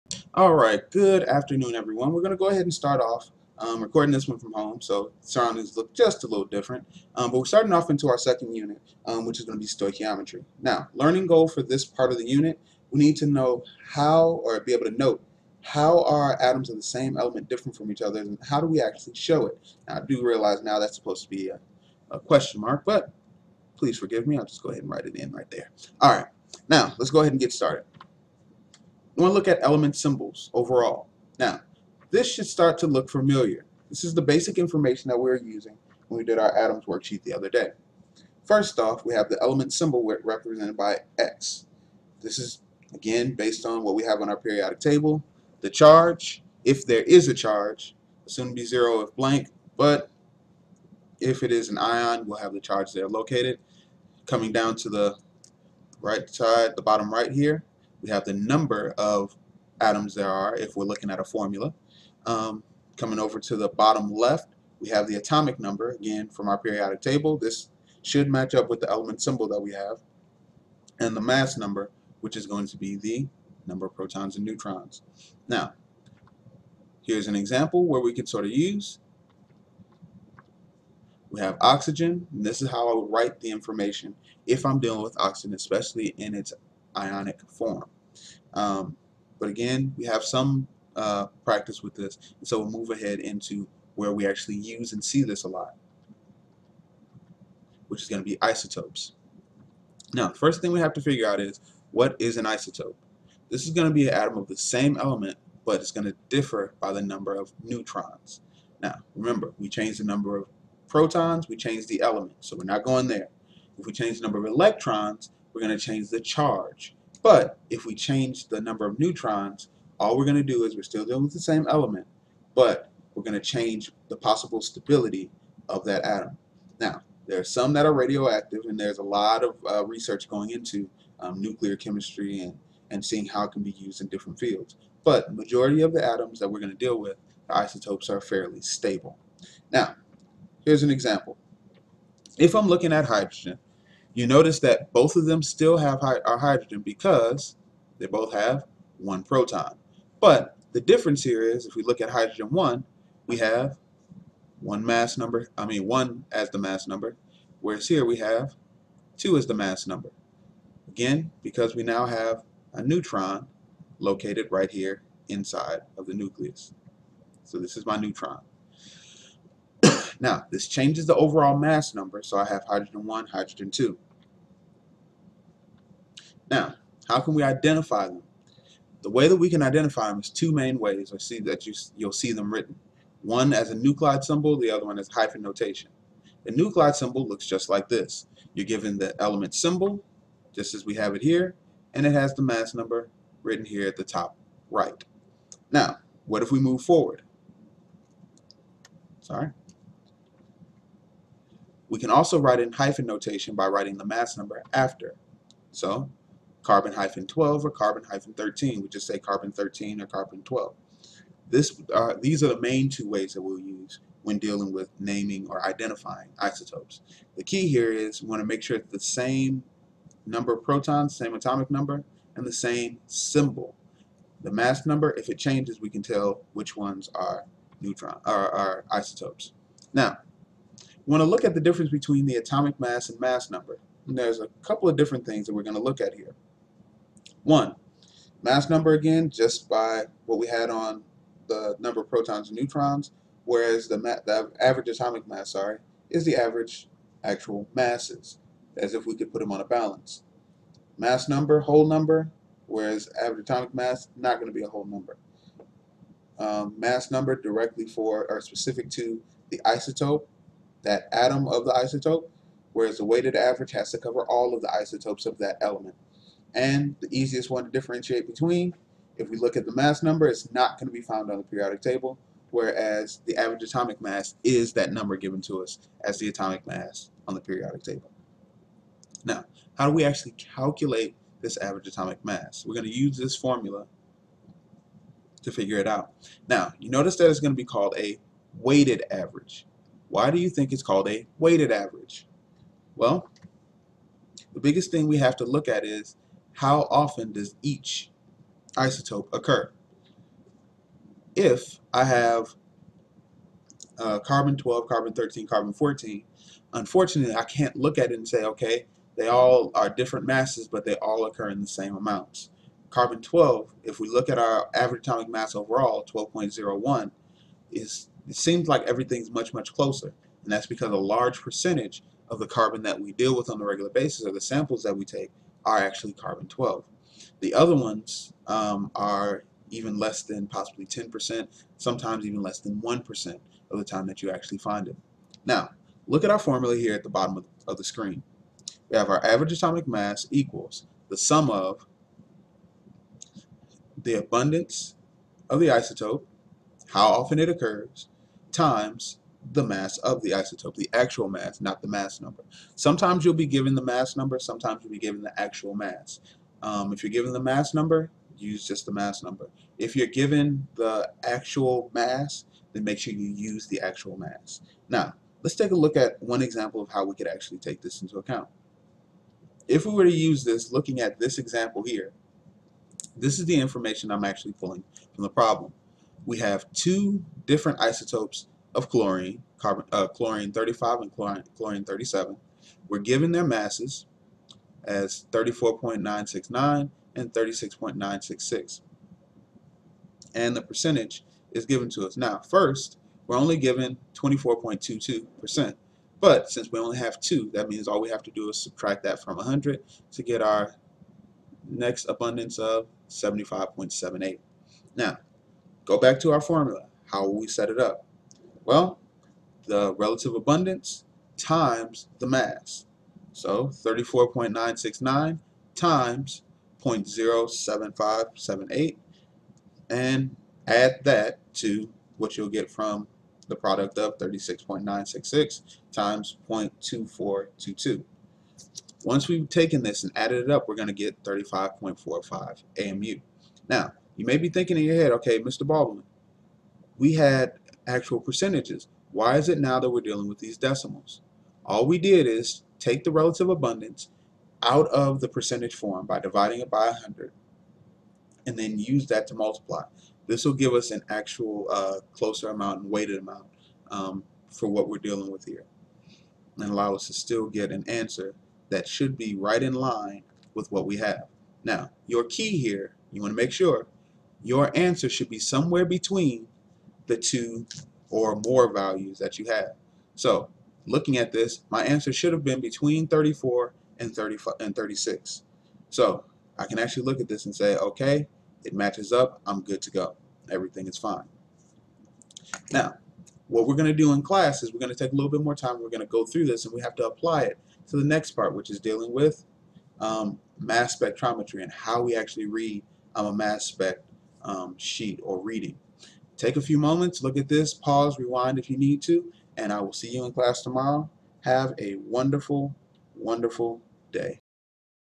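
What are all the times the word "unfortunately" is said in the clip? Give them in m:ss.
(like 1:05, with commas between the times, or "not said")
5:06.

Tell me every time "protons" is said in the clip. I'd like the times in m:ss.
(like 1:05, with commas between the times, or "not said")
1:13, 1:50, 2:29, 3:40, 4:02.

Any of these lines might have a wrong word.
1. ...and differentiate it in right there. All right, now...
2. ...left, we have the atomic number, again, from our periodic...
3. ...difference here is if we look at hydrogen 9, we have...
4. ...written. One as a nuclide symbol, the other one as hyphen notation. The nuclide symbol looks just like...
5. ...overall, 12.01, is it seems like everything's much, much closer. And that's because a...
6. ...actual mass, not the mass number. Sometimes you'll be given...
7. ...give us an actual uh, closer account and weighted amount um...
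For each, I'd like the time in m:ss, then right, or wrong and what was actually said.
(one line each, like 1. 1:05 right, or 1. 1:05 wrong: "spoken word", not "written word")
1. 0:24 wrong: "write", not "differentiate"
2. 1:04 right
3. 2:30 wrong: "1", not "9"
4. 3:02 right
5. 5:15 right
6. 5:50 right
7. 7:30 wrong: "amount", not "account".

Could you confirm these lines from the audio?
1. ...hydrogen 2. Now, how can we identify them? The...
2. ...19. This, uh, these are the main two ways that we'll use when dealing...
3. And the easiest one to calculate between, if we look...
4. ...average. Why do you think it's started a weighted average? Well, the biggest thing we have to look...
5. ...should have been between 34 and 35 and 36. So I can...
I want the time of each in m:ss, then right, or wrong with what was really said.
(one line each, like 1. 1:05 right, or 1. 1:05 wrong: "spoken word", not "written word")
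1. 2:53 right
2. 3:30 wrong: "12", not "19"
3. 4:26 wrong: "differentiate", not "calculate"
4. 4:49 wrong: "called", not "started"
5. 7:52 right.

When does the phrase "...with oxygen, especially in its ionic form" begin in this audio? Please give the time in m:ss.
1:25.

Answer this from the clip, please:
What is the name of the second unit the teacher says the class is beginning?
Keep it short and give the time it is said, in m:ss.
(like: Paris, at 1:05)
Stoichiometry, at 0:09.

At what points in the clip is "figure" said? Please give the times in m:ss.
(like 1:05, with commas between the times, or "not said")
1:41, 4:45.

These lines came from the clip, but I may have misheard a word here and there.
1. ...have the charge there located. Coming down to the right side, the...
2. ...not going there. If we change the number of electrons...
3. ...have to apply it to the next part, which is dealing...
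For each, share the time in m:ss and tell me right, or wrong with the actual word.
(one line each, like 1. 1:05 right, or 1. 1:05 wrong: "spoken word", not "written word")
1. 0:52 right
2. 1:52 right
3. 8:06 right.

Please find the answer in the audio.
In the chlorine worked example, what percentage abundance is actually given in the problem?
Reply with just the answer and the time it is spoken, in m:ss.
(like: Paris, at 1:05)
24.22%, at 6:34.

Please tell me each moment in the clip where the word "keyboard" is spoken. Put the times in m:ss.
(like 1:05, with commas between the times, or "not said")
not said.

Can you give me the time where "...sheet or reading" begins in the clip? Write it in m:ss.
8:14.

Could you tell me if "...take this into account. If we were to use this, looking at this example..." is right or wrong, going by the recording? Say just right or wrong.
right.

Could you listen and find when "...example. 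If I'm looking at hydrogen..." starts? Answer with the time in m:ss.
2:20.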